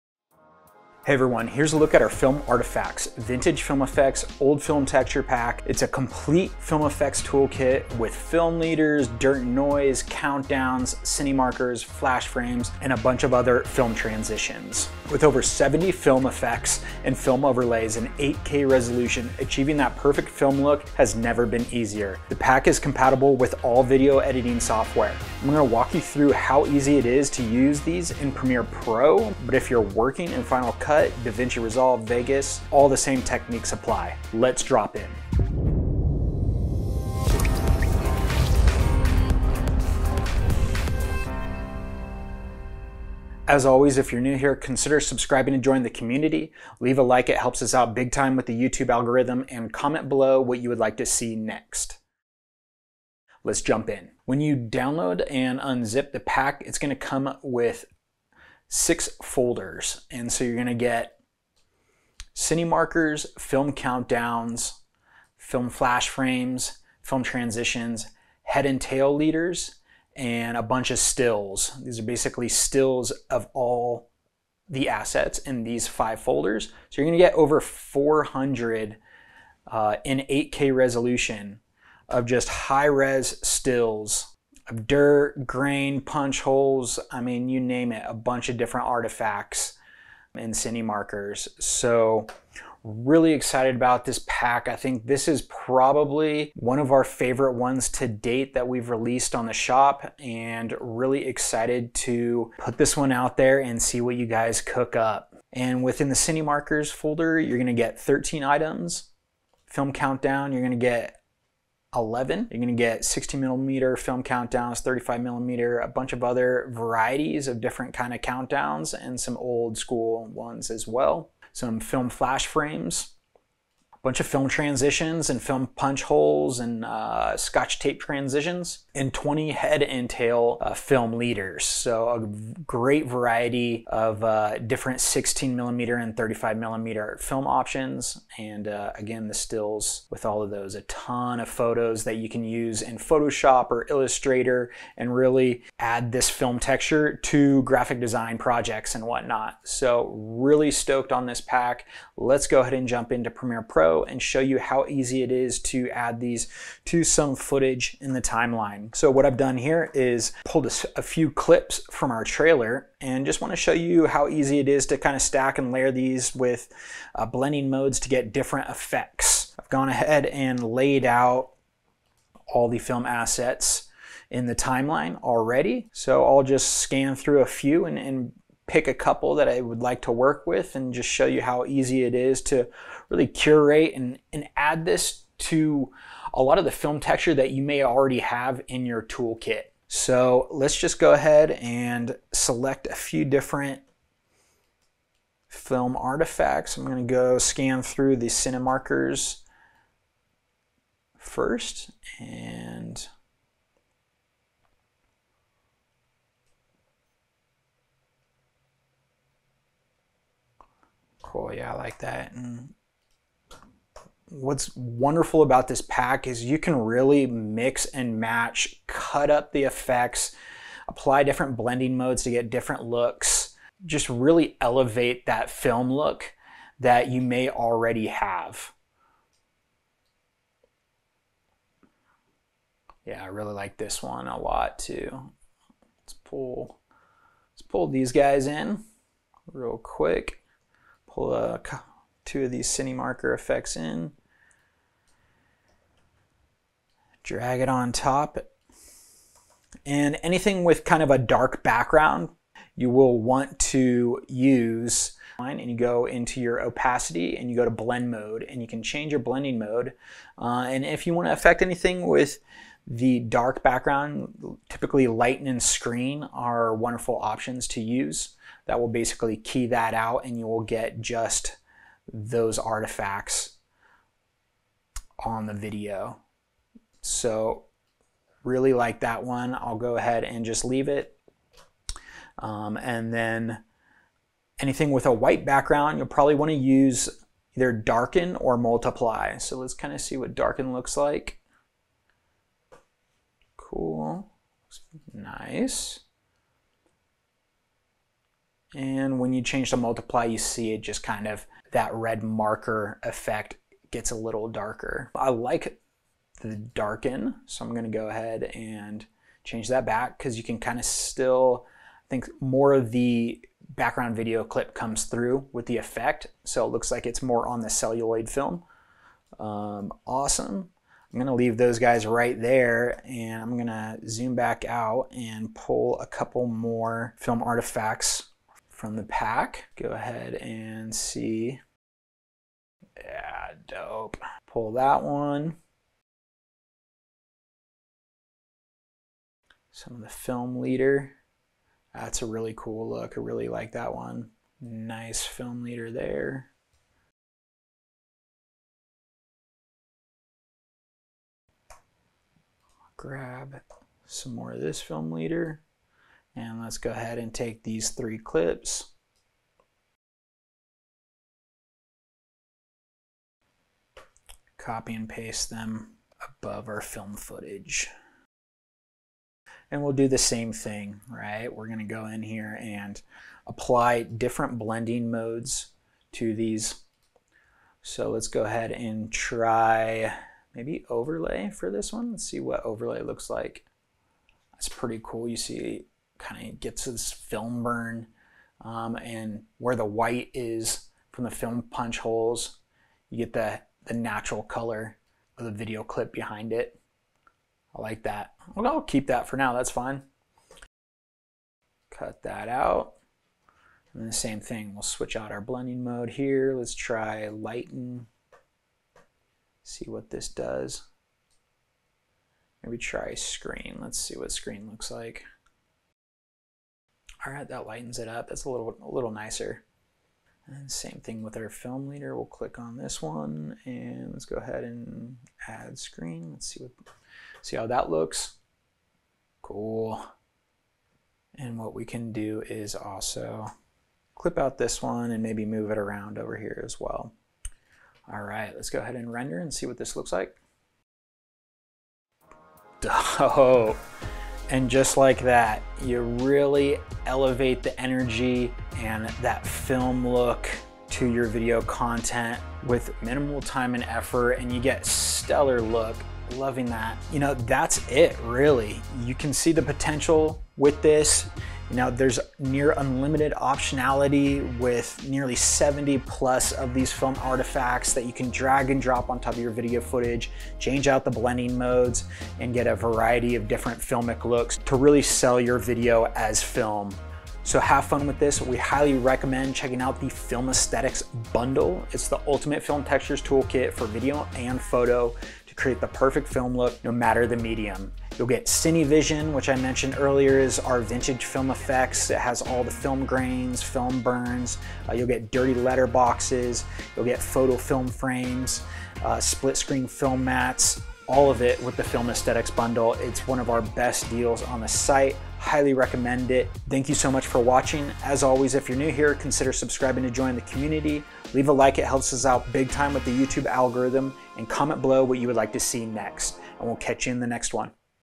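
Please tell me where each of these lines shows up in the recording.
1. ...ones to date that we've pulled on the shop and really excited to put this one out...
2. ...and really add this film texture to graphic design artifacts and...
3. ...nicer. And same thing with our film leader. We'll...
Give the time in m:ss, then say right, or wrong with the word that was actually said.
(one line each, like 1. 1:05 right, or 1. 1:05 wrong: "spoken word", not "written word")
1. 1:37 wrong: "released", not "pulled"
2. 2:24 wrong: "projects", not "artifacts"
3. 6:59 right.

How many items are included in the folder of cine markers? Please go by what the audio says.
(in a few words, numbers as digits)
13.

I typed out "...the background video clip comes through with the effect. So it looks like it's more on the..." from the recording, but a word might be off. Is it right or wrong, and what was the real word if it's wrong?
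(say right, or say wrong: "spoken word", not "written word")
right.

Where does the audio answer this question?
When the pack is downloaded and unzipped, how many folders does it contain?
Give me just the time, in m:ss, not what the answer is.
0:58.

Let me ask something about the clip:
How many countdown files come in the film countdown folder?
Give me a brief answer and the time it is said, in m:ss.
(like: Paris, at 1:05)
11, at 1:50.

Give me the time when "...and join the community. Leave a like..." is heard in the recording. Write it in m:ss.
0:45.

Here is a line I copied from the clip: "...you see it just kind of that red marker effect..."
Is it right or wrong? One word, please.
right.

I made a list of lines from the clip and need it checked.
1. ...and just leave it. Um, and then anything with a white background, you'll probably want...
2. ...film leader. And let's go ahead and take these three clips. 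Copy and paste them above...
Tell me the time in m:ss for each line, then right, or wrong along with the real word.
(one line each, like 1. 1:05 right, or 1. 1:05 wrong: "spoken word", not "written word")
1. 4:40 right
2. 5:54 right.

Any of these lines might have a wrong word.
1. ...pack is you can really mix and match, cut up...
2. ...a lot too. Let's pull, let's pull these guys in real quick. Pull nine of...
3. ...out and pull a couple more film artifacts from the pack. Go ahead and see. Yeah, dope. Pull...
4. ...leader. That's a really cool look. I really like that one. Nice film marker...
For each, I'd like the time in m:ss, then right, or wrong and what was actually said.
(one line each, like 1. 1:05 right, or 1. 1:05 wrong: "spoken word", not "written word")
1. 3:35 right
2. 3:54 wrong: "two", not "nine"
3. 5:24 right
4. 5:40 wrong: "leader", not "marker".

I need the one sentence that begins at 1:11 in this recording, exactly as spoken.
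These are basically stills of all the assets in these five folders.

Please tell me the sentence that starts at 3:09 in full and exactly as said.
So let's just go ahead and select a few different film artifacts.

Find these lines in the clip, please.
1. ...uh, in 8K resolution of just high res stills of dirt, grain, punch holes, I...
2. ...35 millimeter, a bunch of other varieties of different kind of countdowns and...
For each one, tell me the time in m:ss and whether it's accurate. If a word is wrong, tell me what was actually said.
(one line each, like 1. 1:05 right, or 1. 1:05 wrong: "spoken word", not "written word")
1. 1:19 right
2. 1:54 right.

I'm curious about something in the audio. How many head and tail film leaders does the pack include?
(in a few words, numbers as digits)
20.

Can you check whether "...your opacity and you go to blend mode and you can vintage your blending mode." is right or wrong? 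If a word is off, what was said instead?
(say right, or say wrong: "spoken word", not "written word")
wrong: "change", not "vintage".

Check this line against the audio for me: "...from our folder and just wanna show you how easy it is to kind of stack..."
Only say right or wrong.
wrong.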